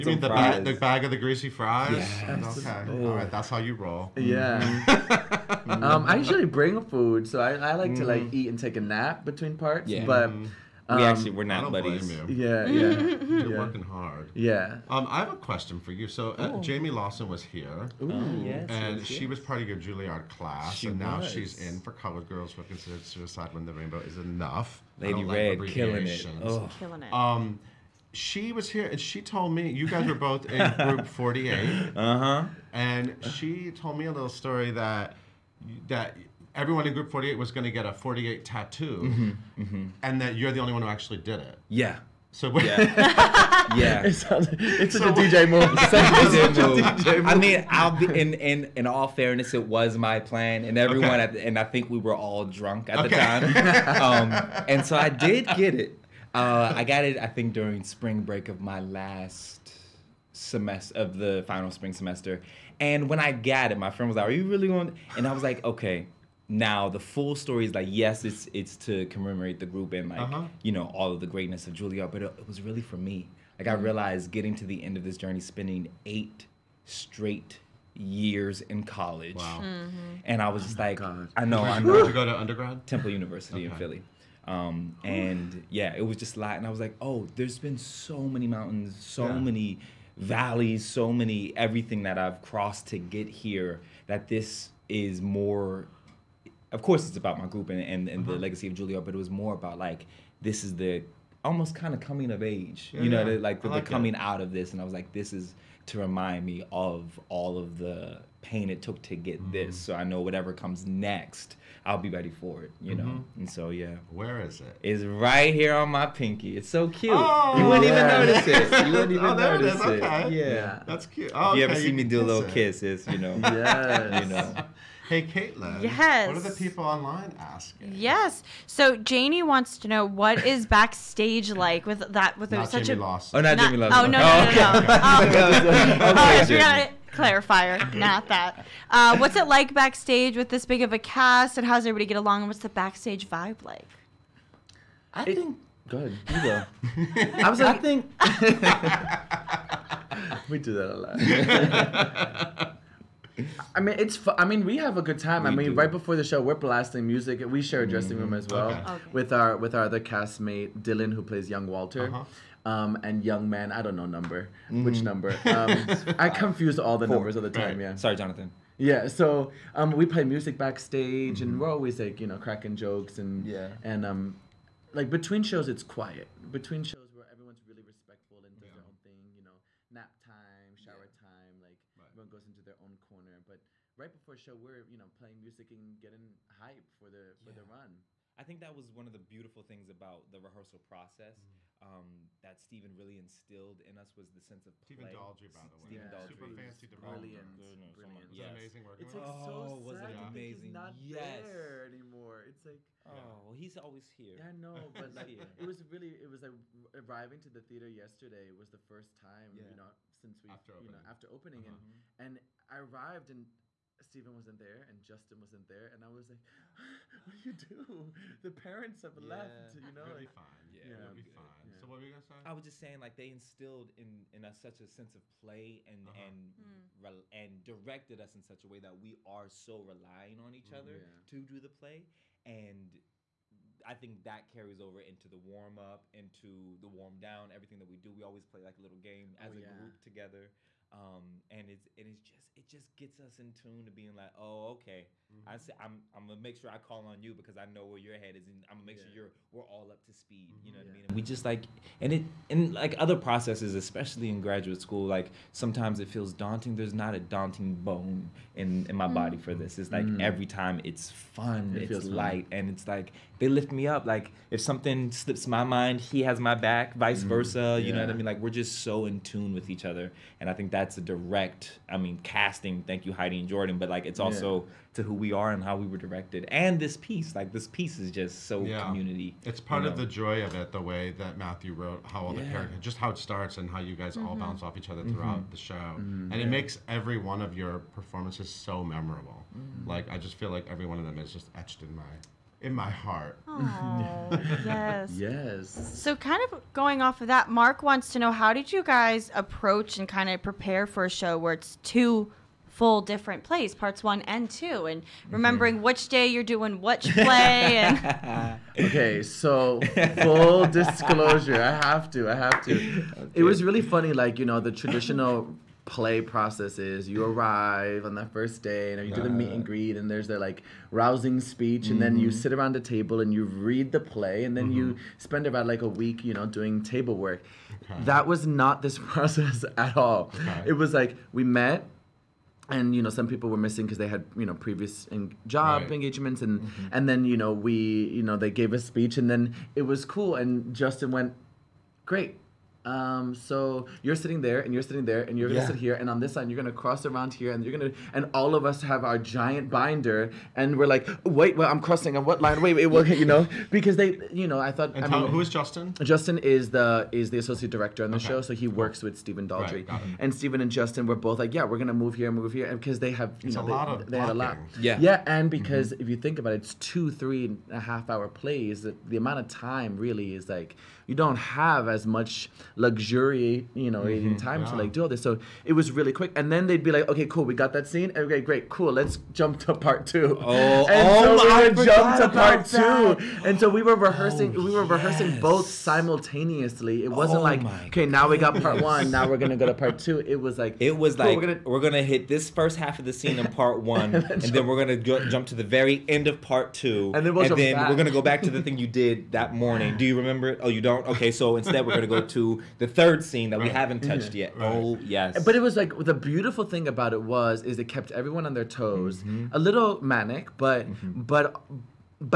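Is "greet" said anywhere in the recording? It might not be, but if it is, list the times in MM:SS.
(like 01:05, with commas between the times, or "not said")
05:19.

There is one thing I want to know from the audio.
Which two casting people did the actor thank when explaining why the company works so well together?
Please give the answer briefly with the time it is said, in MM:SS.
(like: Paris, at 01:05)
Heidi and Jordan, at 04:33.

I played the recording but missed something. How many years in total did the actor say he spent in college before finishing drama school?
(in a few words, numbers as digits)
8.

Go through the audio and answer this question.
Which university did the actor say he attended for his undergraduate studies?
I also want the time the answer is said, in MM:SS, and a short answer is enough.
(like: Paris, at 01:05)
Temple University, at 01:22.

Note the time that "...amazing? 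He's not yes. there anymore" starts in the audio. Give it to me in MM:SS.
03:20.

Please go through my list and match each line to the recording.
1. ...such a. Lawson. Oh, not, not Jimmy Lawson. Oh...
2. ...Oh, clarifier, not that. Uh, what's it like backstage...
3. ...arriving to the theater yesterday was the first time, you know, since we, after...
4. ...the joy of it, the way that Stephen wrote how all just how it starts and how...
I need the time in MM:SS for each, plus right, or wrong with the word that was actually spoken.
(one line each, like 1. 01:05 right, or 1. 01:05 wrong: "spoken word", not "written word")
1. 02:12 right
2. 02:17 right
3. 03:26 right
4. 04:40 wrong: "Matthew", not "Stephen".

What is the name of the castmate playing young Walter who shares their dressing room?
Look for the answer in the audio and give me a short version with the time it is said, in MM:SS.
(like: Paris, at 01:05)
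Dylan, at 02:40.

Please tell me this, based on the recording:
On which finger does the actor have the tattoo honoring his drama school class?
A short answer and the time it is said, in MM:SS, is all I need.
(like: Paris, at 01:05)
Pinky, at 01:56.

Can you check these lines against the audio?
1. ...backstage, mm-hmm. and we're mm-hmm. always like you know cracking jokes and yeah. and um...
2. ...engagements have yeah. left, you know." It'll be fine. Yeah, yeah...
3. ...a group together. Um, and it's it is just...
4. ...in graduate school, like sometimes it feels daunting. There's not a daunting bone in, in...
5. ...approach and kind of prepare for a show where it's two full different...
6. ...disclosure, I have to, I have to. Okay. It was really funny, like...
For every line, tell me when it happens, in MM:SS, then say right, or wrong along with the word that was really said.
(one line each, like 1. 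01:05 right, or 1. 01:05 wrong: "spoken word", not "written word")
1. 02:50 right
2. 03:38 wrong: "parents", not "engagements"
3. 03:59 right
4. 04:14 right
5. 04:59 right
6. 05:10 right.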